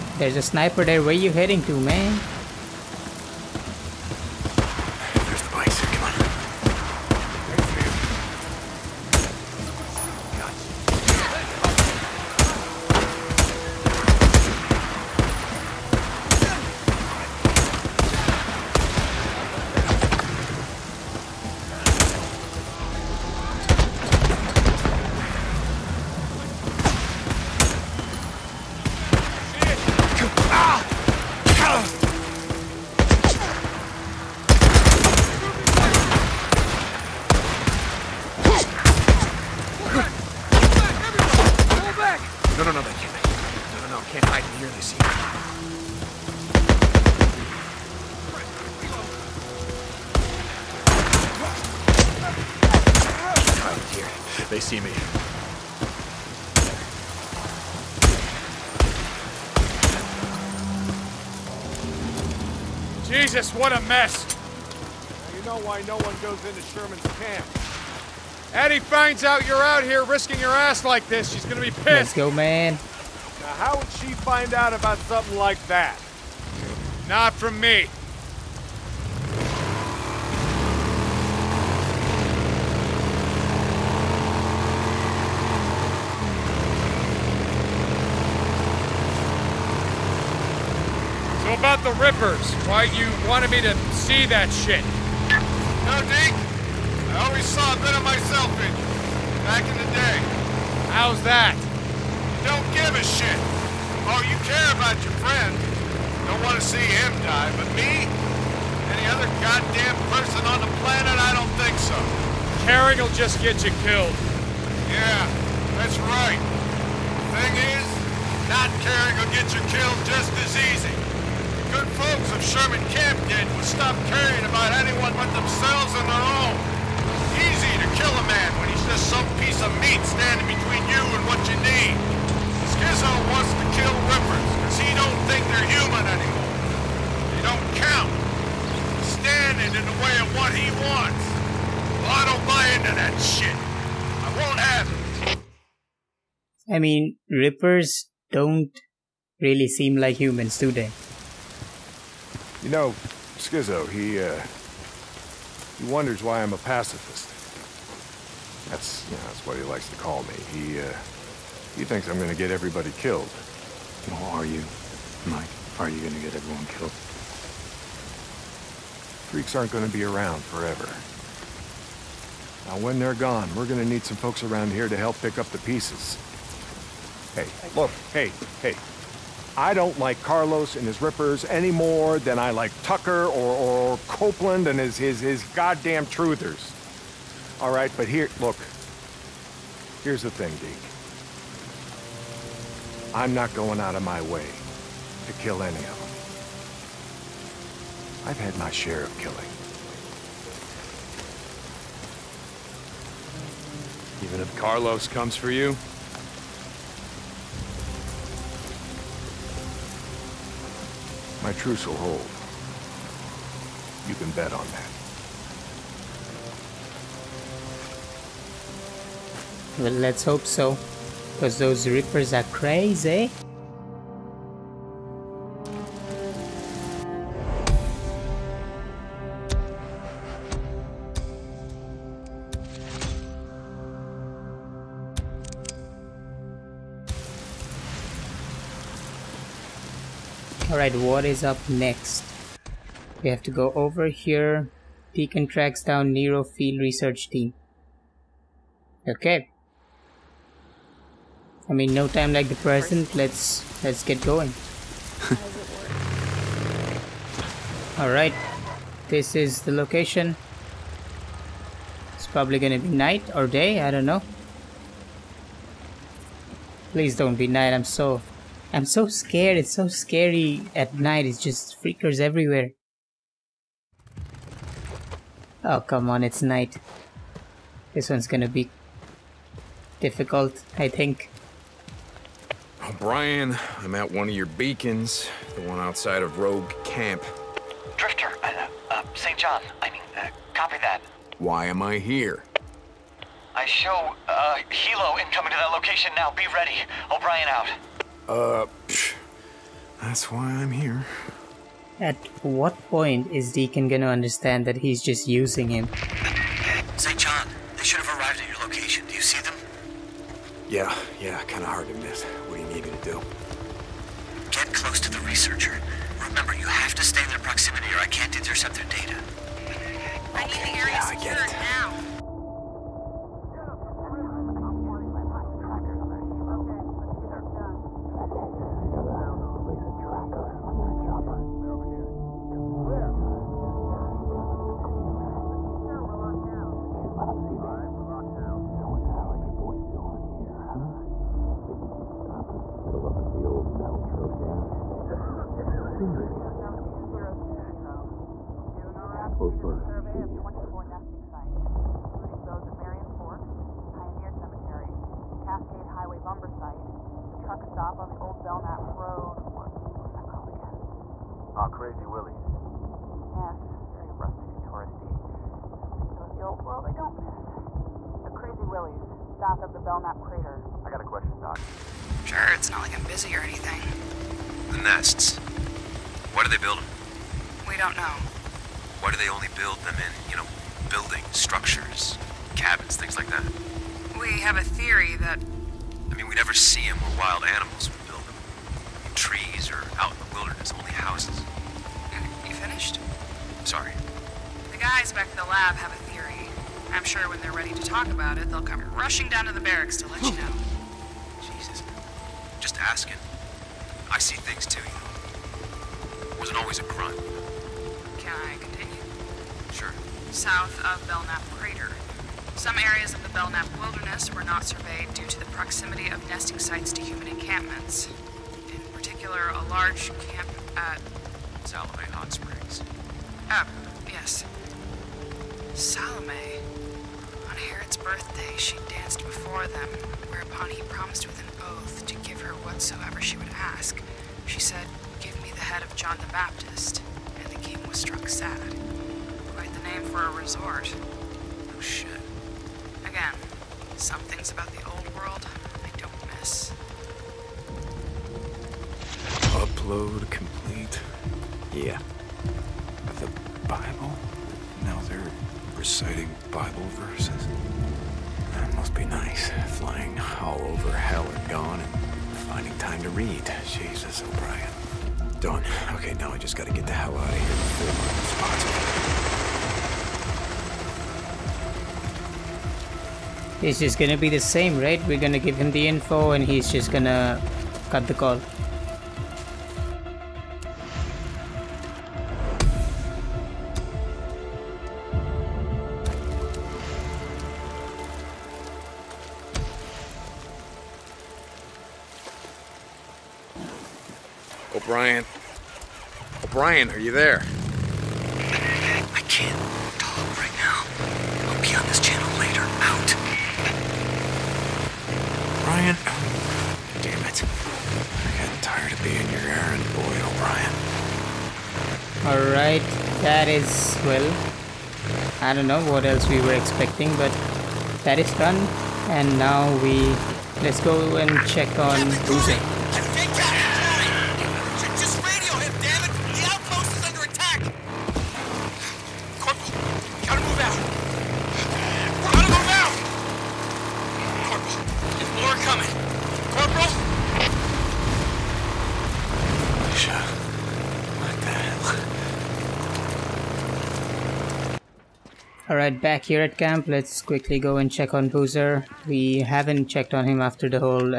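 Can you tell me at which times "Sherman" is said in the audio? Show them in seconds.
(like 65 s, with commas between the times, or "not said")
66 s, 122 s.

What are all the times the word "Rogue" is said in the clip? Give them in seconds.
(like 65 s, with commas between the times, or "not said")
286 s.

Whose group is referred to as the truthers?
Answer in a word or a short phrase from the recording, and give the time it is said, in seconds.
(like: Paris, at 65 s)
Copeland, at 184 s.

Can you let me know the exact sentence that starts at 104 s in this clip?
Oh, you care about your friend.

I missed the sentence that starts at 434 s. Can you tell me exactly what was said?
She said, Give me the head of John the Baptist.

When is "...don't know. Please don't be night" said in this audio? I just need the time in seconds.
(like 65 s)
263 s.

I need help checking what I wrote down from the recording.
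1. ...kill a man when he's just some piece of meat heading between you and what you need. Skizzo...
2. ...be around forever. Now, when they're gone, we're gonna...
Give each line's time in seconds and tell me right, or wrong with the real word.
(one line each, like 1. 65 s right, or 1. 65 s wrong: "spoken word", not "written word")
1. 127 s wrong: "standing", not "heading"
2. 169 s right.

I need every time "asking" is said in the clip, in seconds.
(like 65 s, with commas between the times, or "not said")
402 s.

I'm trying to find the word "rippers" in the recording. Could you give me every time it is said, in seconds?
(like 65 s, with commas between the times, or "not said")
92 s, 147 s, 181 s.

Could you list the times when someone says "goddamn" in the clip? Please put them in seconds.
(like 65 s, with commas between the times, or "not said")
109 s, 185 s.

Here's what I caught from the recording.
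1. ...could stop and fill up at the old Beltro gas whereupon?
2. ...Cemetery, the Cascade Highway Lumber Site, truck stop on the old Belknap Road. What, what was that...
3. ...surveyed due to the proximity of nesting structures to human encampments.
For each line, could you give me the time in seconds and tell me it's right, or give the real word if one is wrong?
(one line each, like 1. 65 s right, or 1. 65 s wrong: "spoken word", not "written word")
1. 341 s wrong: "station", not "whereupon"
2. 354 s right
3. 414 s wrong: "sites", not "structures".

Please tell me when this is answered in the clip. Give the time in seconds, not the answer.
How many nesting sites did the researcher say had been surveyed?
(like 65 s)
350 s.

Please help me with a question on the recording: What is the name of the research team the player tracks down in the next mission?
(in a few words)
Nero Field Research Team.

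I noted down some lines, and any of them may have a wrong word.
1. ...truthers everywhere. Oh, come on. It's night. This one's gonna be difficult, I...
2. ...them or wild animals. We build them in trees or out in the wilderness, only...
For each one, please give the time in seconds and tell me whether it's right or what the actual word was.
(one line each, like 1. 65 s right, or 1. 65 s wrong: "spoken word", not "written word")
1. 271 s wrong: "freakers", not "truthers"
2. 386 s right.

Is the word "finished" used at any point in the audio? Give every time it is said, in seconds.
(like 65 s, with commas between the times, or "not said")
392 s.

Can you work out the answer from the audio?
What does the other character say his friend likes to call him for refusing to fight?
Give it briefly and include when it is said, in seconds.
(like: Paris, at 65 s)
pacifist, at 156 s.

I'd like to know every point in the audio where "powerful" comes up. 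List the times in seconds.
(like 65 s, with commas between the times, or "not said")
not said.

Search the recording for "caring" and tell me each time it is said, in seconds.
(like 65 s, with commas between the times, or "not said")
112 s, 118 s, 124 s.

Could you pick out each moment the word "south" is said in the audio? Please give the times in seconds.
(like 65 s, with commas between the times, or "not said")
369 s, 410 s.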